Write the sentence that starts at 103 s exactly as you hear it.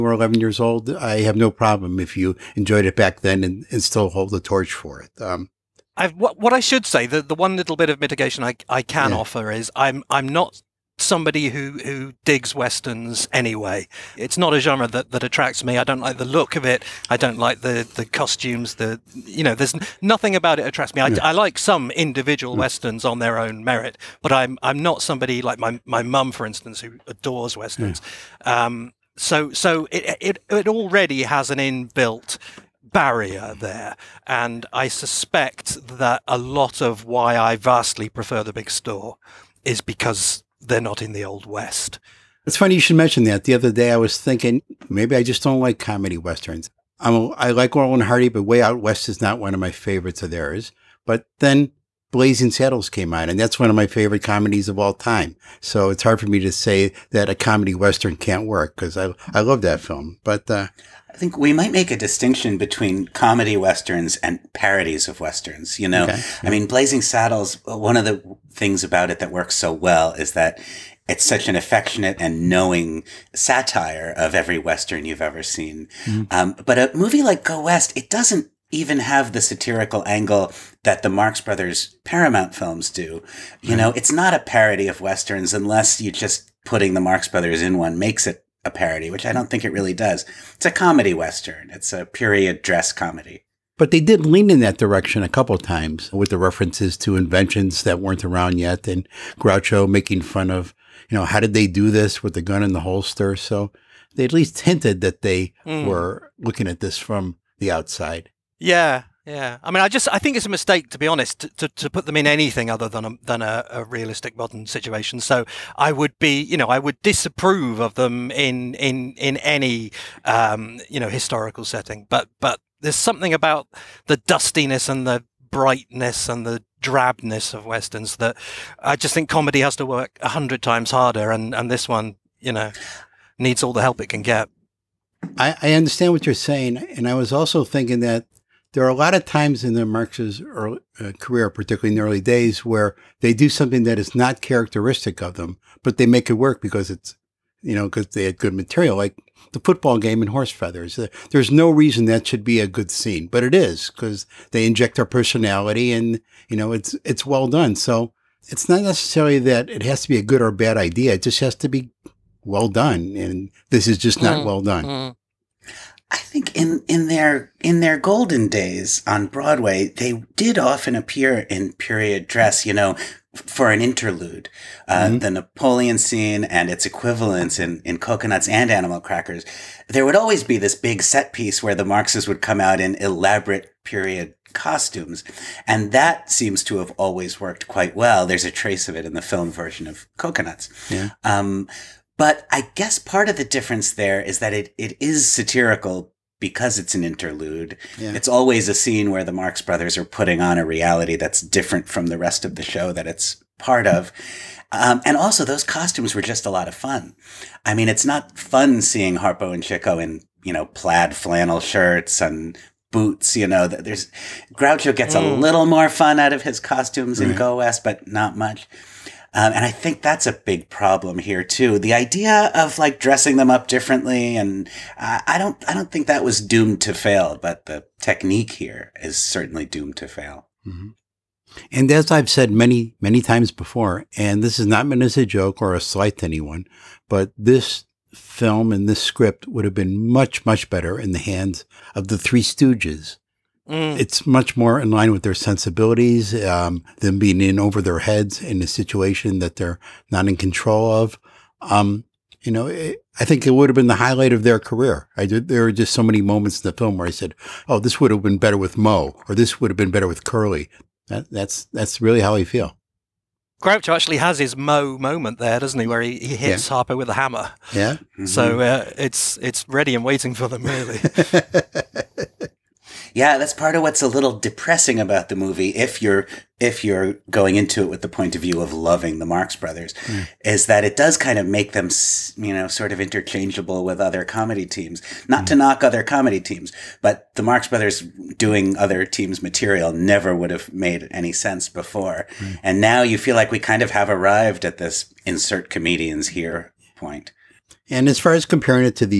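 So they at least hinted that they mm.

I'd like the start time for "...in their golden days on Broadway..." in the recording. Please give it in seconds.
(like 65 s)
167 s.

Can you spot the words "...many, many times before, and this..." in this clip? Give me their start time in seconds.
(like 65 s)
232 s.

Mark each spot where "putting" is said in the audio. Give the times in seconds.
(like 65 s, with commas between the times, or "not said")
86 s, 200 s.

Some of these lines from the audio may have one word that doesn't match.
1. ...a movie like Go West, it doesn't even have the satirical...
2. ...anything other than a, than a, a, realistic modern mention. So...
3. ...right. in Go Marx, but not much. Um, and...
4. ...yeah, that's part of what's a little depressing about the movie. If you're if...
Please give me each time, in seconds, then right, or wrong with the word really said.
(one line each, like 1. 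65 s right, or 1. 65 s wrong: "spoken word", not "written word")
1. 76 s right
2. 112 s wrong: "situation", not "mention"
3. 217 s wrong: "West", not "Marx"
4. 273 s right.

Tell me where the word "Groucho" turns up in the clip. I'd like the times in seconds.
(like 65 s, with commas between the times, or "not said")
99 s, 214 s, 263 s.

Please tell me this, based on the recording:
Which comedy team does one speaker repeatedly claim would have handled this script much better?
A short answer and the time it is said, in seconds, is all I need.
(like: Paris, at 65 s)
The Three Stooges, at 242 s.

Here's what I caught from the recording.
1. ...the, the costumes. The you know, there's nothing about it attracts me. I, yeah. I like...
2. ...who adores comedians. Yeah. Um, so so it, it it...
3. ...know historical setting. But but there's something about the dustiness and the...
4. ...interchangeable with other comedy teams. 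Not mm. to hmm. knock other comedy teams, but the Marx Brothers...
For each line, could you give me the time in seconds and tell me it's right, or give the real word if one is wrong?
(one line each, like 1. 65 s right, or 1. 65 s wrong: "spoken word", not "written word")
1. 17 s right
2. 26 s wrong: "westerns", not "comedians"
3. 120 s right
4. 282 s right.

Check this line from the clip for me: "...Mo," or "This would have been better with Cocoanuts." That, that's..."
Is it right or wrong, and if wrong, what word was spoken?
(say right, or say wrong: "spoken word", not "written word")
wrong: "Curly", not "Cocoanuts".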